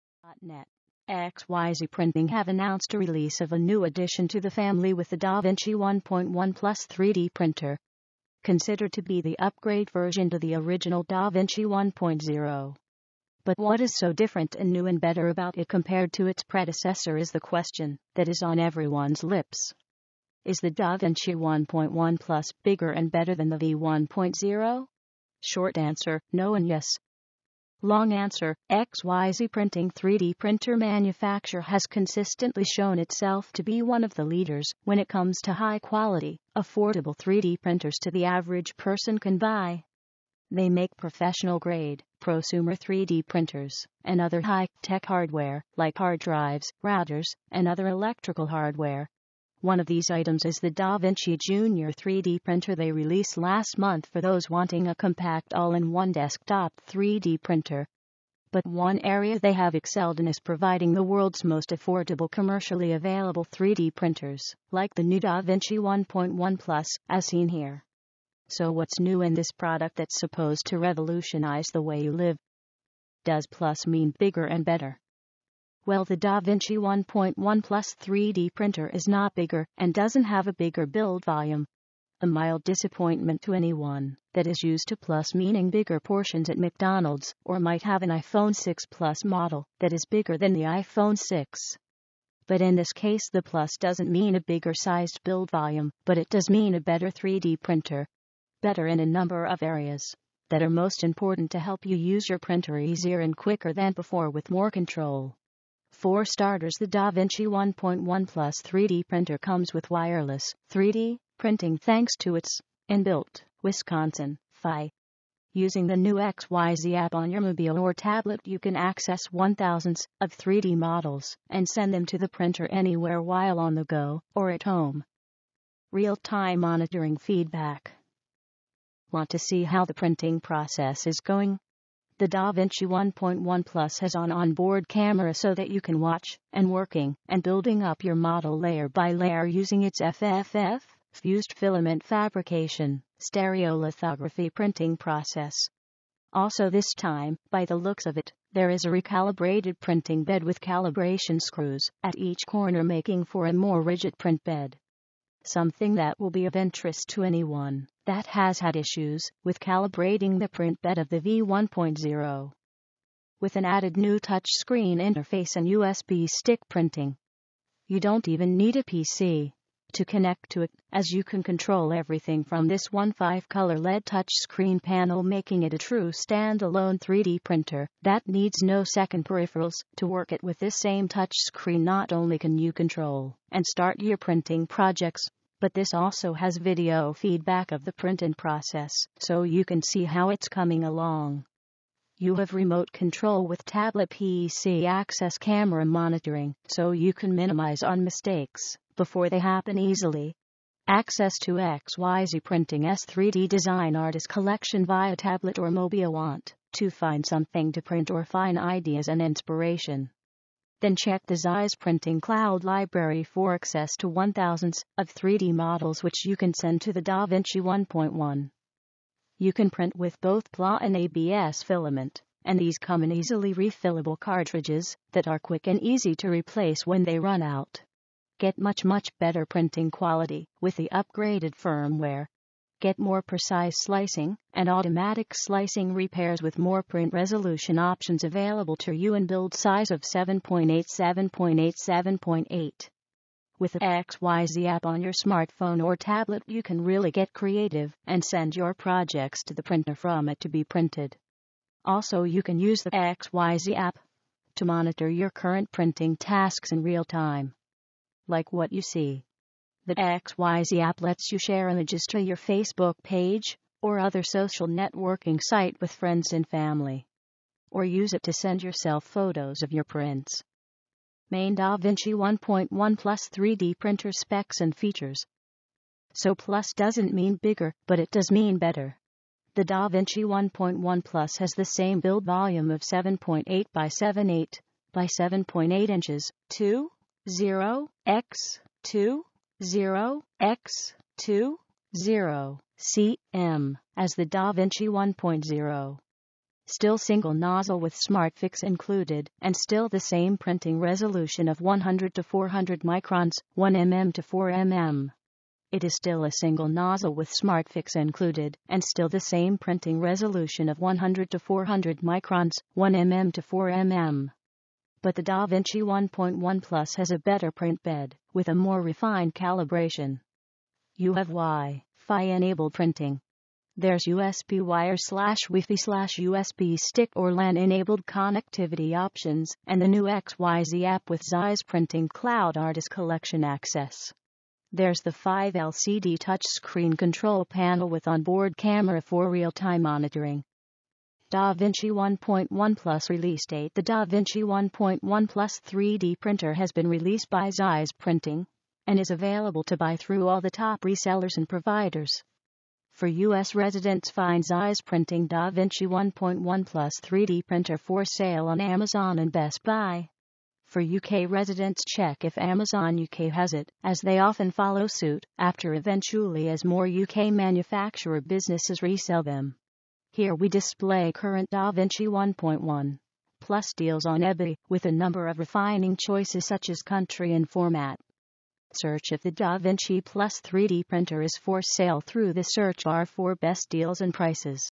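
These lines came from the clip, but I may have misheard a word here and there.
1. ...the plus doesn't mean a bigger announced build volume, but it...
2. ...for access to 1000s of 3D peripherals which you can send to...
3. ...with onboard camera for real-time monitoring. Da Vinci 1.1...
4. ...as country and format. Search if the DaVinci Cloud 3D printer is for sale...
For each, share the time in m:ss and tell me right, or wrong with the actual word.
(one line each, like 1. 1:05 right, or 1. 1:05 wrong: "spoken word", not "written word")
1. 1:33 wrong: "sized", not "announced"
2. 3:33 wrong: "models", not "peripherals"
3. 5:37 right
4. 6:16 wrong: "Plus", not "Cloud".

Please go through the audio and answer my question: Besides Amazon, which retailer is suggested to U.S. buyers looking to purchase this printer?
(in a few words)
Best Buy.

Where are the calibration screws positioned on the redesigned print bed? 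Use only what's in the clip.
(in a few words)
at each corner.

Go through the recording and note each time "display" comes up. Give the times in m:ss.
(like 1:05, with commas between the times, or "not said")
6:10.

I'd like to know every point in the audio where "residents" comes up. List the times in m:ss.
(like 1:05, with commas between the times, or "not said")
5:53, 6:01.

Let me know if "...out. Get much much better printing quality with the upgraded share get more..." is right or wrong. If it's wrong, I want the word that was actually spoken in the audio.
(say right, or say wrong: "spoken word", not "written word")
wrong: "firmware", not "share".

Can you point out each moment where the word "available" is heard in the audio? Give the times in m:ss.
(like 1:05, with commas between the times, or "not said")
1:02, 3:58, 5:49.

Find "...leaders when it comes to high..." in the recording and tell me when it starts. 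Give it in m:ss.
0:34.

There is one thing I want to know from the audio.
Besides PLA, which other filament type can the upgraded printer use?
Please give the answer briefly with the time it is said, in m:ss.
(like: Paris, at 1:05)
ABS, at 3:40.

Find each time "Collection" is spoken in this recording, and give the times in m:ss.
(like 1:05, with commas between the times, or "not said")
3:24, 5:32.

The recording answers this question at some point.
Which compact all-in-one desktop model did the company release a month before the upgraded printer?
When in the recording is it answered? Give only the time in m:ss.
0:50.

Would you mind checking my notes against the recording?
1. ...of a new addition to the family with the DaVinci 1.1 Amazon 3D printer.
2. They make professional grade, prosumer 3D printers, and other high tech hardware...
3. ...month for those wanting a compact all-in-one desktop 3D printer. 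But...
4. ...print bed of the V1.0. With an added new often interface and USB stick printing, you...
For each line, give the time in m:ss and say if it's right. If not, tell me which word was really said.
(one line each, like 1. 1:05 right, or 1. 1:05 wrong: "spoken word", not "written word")
1. 0:03 wrong: "Plus", not "Amazon"
2. 0:40 right
3. 0:53 right
4. 2:40 wrong: "touchscreen", not "often".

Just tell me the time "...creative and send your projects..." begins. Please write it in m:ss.
4:07.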